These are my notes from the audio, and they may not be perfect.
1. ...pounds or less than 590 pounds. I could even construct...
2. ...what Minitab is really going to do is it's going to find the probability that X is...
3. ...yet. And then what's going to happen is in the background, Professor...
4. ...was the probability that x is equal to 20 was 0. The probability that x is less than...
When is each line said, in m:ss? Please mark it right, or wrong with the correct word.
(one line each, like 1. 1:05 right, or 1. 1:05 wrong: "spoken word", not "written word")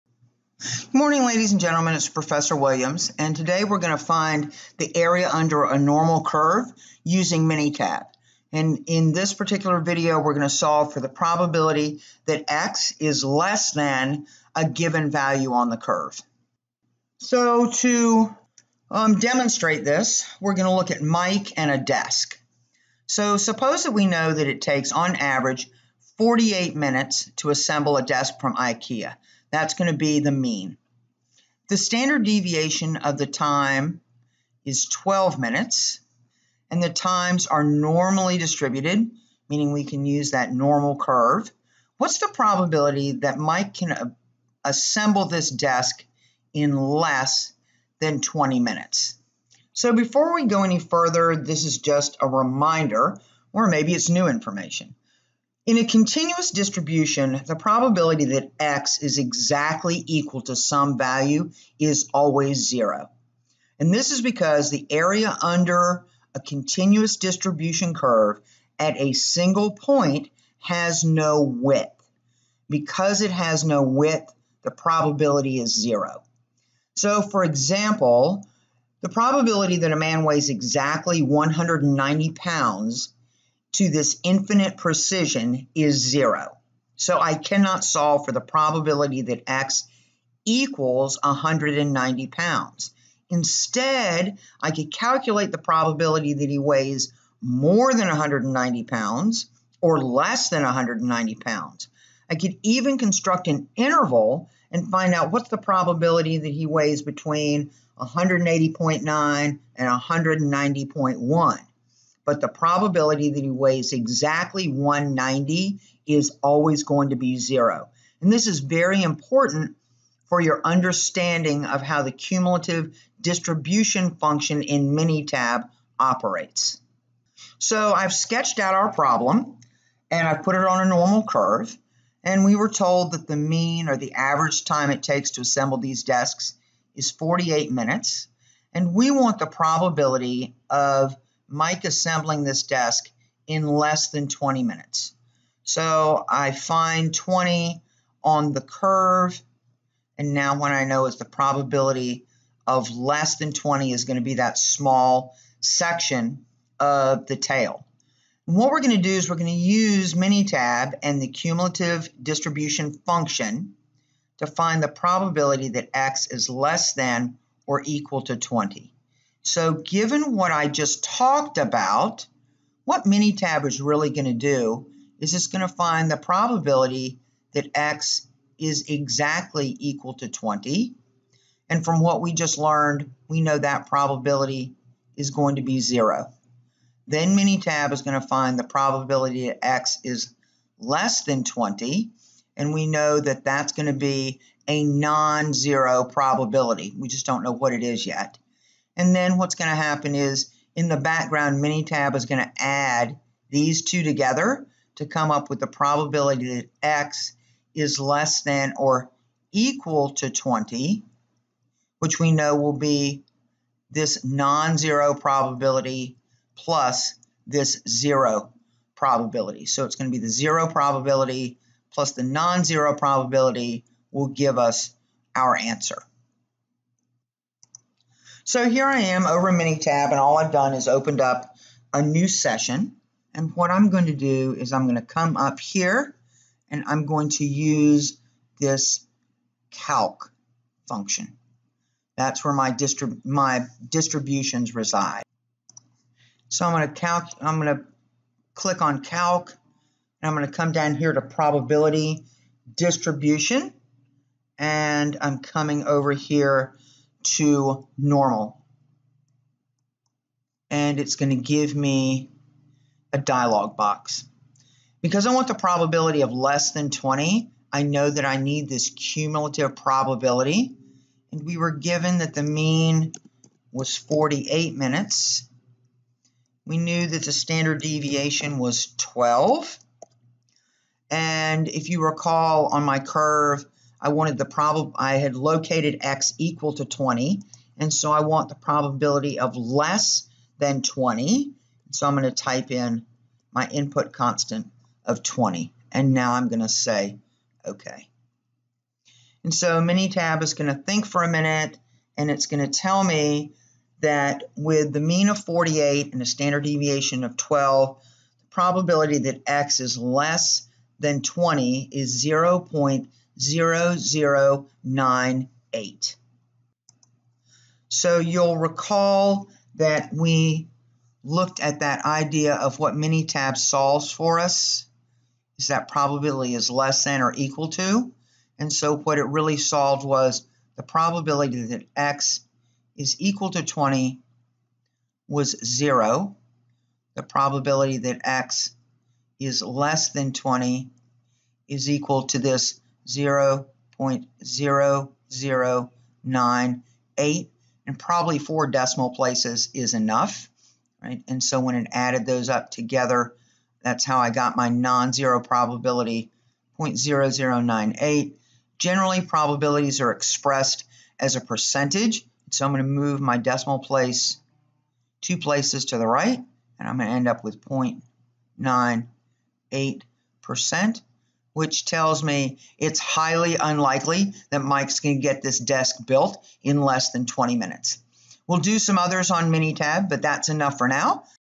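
1. 1:38 wrong: "190", not "590"
2. 2:52 right
3. 3:18 wrong: "Minitab", not "Professor"
4. 5:30 right.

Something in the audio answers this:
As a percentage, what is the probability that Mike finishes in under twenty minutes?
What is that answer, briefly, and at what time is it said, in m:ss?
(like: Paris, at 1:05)
0.98%, at 6:07.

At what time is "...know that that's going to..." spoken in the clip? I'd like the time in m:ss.
3:12.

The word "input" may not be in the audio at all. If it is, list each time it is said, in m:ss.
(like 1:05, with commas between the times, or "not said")
4:53.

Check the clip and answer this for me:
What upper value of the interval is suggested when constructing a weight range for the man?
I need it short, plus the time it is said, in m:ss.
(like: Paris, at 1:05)
190.1, at 1:50.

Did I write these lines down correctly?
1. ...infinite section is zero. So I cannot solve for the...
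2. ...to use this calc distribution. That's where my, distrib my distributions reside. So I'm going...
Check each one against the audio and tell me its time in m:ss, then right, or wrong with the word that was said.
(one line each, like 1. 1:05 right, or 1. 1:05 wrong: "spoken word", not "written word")
1. 1:24 wrong: "precision", not "section"
2. 3:57 wrong: "function", not "distribution".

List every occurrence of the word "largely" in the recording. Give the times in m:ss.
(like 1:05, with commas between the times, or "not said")
not said.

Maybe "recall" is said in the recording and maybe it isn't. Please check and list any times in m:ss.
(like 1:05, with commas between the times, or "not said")
4:42, 5:18.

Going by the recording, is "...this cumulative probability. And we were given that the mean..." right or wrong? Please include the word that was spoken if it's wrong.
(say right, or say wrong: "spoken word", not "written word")
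right.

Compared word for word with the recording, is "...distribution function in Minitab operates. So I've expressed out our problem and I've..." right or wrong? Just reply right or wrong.
wrong.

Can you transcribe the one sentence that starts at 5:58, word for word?
Generally, probabilities are expressed as a percentage.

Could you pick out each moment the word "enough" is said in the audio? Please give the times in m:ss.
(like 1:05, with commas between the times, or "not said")
5:49, 6:20.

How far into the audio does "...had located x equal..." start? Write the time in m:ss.
4:45.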